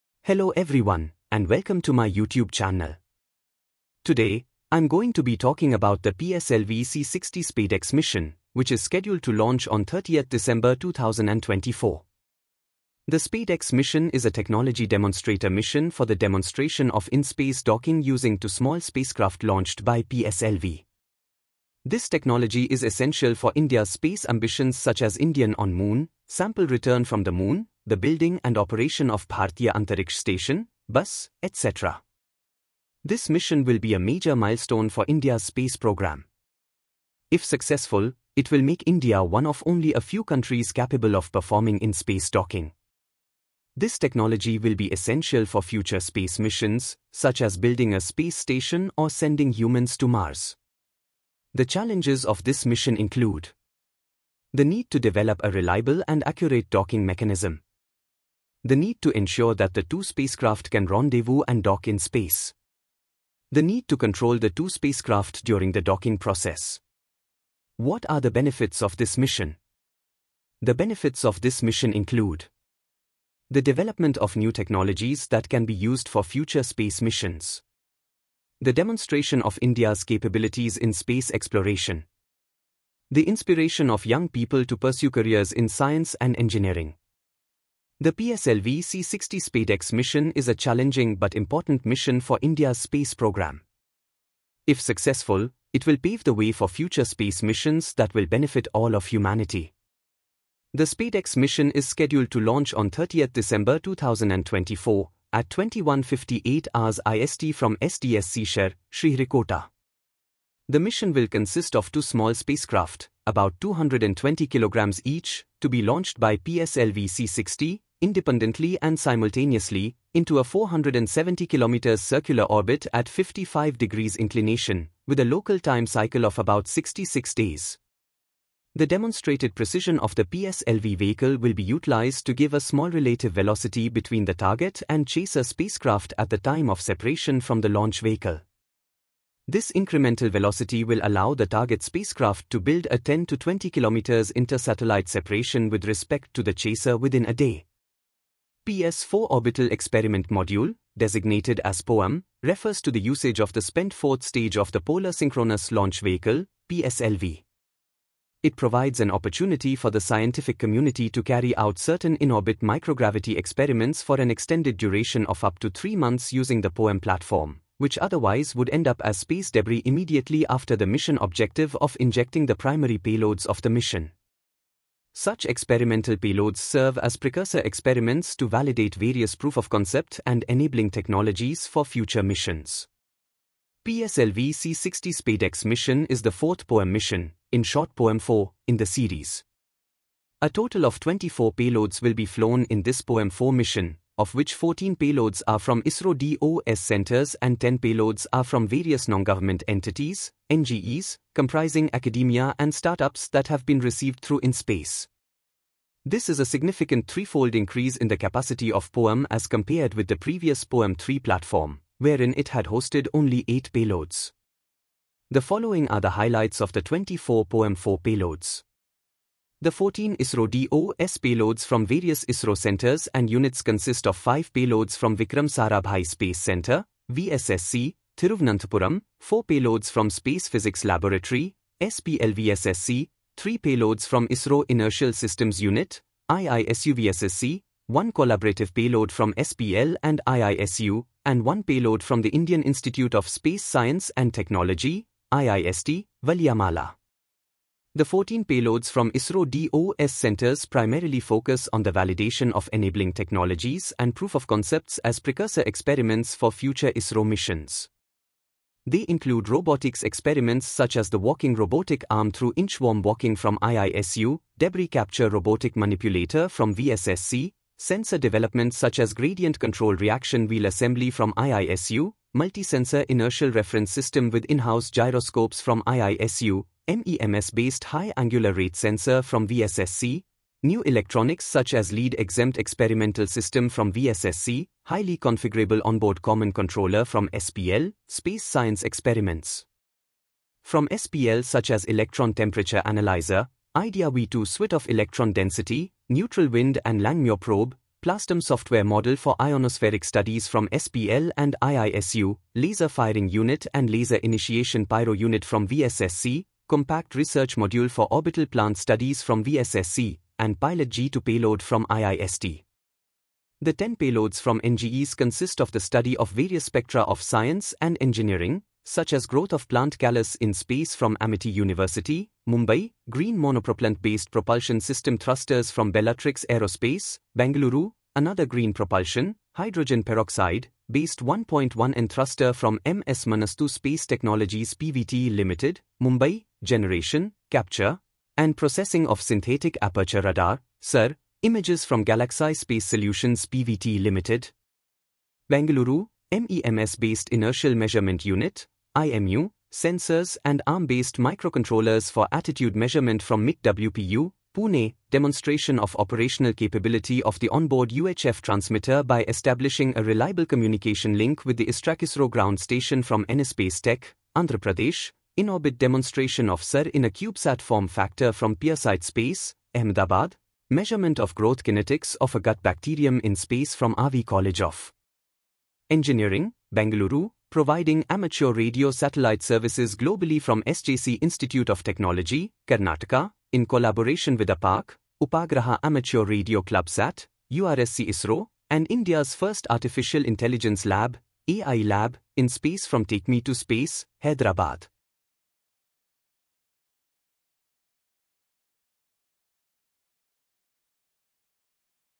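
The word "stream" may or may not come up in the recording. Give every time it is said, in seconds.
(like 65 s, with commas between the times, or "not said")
not said.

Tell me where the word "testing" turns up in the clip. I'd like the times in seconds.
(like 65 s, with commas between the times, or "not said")
not said.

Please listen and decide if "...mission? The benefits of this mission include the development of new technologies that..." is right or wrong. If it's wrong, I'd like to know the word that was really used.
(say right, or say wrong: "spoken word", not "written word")
right.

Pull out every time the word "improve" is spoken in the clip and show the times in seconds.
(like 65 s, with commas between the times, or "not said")
not said.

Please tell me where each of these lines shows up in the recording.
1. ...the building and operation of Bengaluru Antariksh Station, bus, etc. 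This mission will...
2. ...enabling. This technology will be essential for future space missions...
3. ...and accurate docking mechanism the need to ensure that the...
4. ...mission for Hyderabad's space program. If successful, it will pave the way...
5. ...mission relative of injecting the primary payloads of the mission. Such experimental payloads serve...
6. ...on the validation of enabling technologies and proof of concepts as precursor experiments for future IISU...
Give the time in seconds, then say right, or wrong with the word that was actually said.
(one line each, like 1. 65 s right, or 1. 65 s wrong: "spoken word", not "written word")
1. 27 s wrong: "Bharatiya", not "Bengaluru"
2. 42 s wrong: "docking", not "enabling"
3. 56 s right
4. 91 s wrong: "India", not "Hyderabad"
5. 170 s wrong: "objective", not "relative"
6. 251 s wrong: "ISRO", not "IISU".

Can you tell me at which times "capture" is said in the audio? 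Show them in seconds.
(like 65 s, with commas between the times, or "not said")
264 s, 337 s.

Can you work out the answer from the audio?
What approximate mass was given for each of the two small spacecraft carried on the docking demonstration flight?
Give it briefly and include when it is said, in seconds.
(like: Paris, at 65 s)
220 kilograms, at 113 s.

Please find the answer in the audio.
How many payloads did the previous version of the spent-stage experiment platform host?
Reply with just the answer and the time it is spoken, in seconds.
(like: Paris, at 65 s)
8, at 213 s.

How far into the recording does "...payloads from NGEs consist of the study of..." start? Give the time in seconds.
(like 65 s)
313 s.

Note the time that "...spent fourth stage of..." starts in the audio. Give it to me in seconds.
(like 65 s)
153 s.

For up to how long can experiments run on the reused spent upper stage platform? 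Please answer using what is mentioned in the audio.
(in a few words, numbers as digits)
three months.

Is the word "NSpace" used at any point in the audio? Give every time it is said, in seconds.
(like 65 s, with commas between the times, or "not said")
363 s.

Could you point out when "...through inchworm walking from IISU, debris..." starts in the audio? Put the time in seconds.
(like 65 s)
262 s.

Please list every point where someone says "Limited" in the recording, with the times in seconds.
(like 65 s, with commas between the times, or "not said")
335 s, 344 s.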